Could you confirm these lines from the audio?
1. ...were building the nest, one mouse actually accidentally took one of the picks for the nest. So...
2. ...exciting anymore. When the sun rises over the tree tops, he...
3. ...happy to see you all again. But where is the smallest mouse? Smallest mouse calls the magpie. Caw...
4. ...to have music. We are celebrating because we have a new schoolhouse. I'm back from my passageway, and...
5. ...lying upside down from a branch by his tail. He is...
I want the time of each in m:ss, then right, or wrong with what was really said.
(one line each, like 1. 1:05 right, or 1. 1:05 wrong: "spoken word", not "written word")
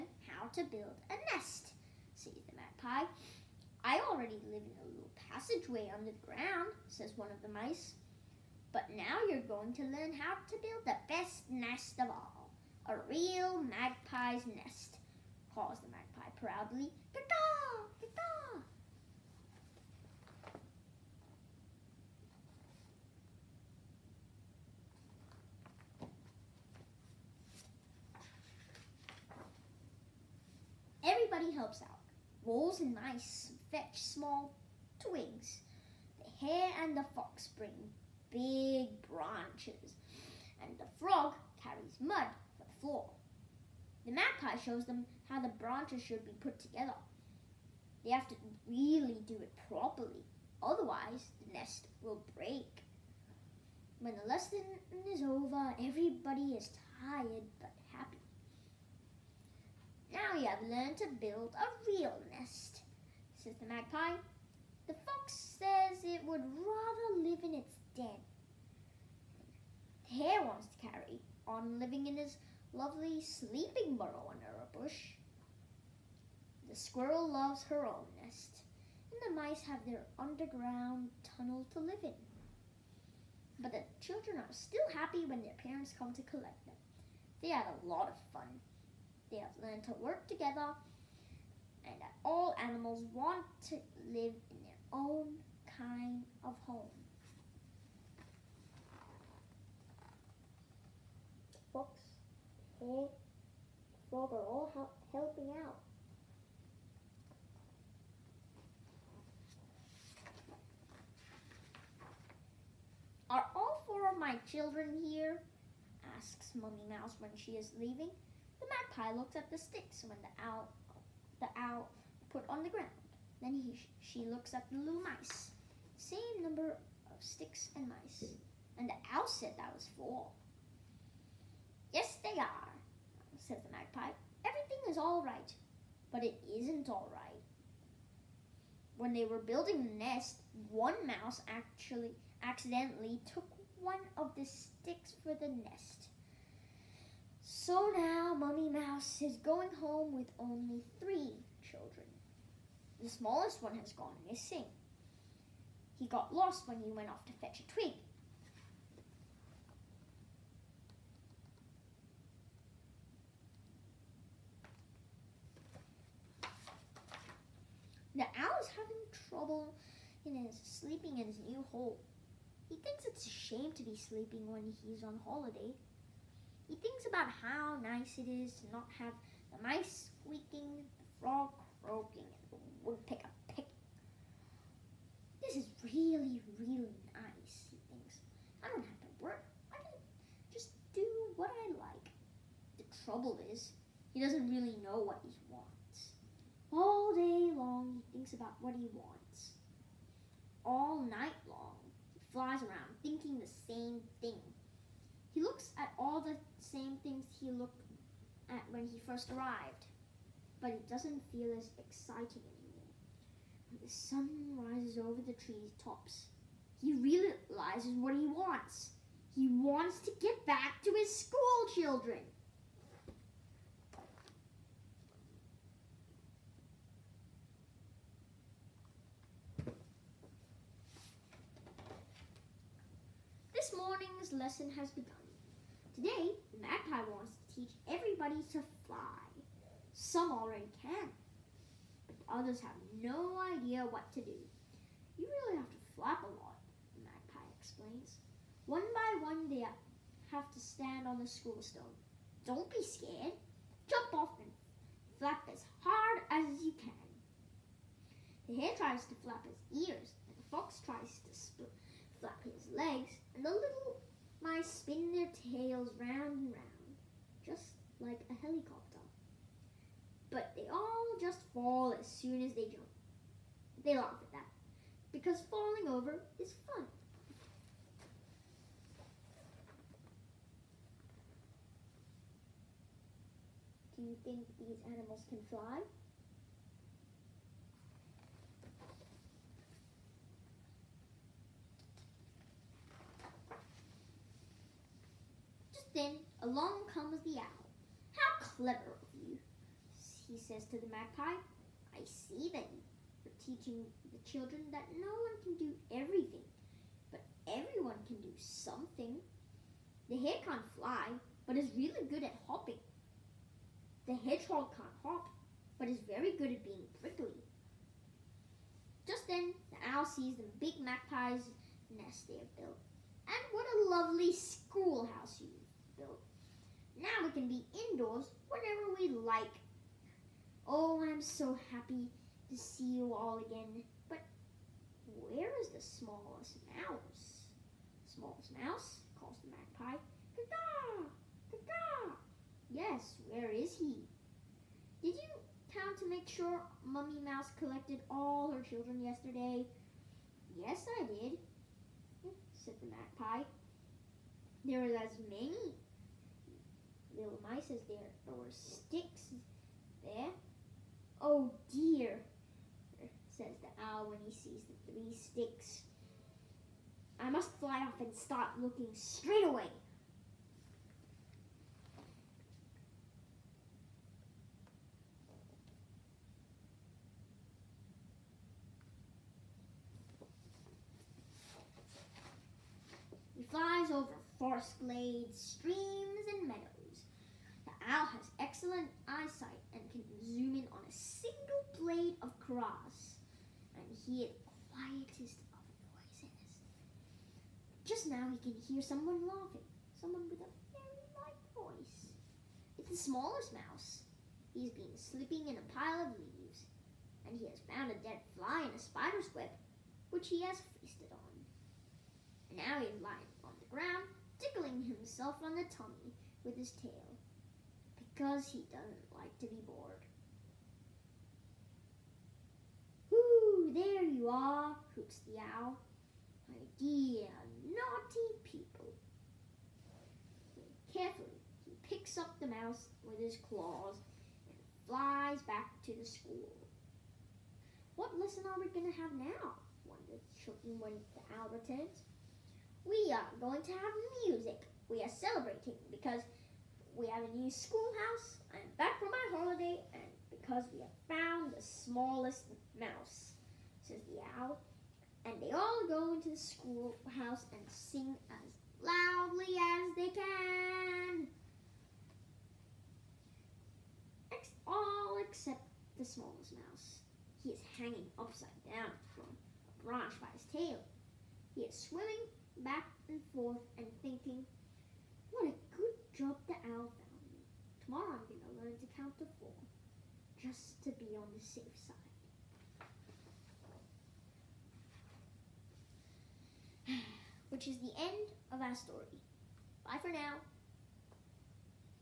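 1. 2:19 wrong: "sticks", not "picks"
2. 3:31 right
3. 5:31 right
4. 7:23 wrong: "holiday", not "passageway"
5. 7:47 wrong: "hanging", not "lying".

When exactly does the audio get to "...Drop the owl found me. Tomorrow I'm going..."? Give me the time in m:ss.
7:56.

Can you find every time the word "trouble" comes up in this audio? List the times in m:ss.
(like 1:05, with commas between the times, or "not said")
2:49, 3:13.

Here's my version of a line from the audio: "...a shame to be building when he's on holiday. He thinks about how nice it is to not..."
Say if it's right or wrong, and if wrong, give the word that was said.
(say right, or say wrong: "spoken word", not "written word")
wrong: "sleeping", not "building".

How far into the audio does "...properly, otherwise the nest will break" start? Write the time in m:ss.
0:49.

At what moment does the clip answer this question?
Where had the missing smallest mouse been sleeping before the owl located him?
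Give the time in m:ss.
6:45.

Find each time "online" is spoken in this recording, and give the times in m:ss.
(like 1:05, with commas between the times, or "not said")
not said.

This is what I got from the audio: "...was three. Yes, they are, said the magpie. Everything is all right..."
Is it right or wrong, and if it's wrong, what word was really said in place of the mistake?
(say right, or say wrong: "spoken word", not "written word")
wrong: "four", not "three".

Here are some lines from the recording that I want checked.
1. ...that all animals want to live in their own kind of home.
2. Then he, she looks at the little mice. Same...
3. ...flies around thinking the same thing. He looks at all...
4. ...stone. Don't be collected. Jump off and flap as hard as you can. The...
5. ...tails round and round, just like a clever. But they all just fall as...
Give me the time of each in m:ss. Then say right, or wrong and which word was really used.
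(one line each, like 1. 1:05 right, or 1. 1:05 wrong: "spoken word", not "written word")
1. 1:32 right
2. 2:03 right
3. 3:22 right
4. 4:11 wrong: "scared", not "collected"
5. 4:25 wrong: "helicopter", not "clever".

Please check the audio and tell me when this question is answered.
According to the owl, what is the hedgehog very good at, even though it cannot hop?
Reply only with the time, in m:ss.
5:16.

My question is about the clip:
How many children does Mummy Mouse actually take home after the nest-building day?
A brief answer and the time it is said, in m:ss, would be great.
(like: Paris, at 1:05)
3, at 2:30.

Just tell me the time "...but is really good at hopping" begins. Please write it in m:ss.
5:11.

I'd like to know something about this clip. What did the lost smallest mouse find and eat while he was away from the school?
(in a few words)
A dead fly.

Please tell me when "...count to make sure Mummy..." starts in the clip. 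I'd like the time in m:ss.
5:45.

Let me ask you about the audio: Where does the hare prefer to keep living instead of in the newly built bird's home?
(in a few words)
Under a bush.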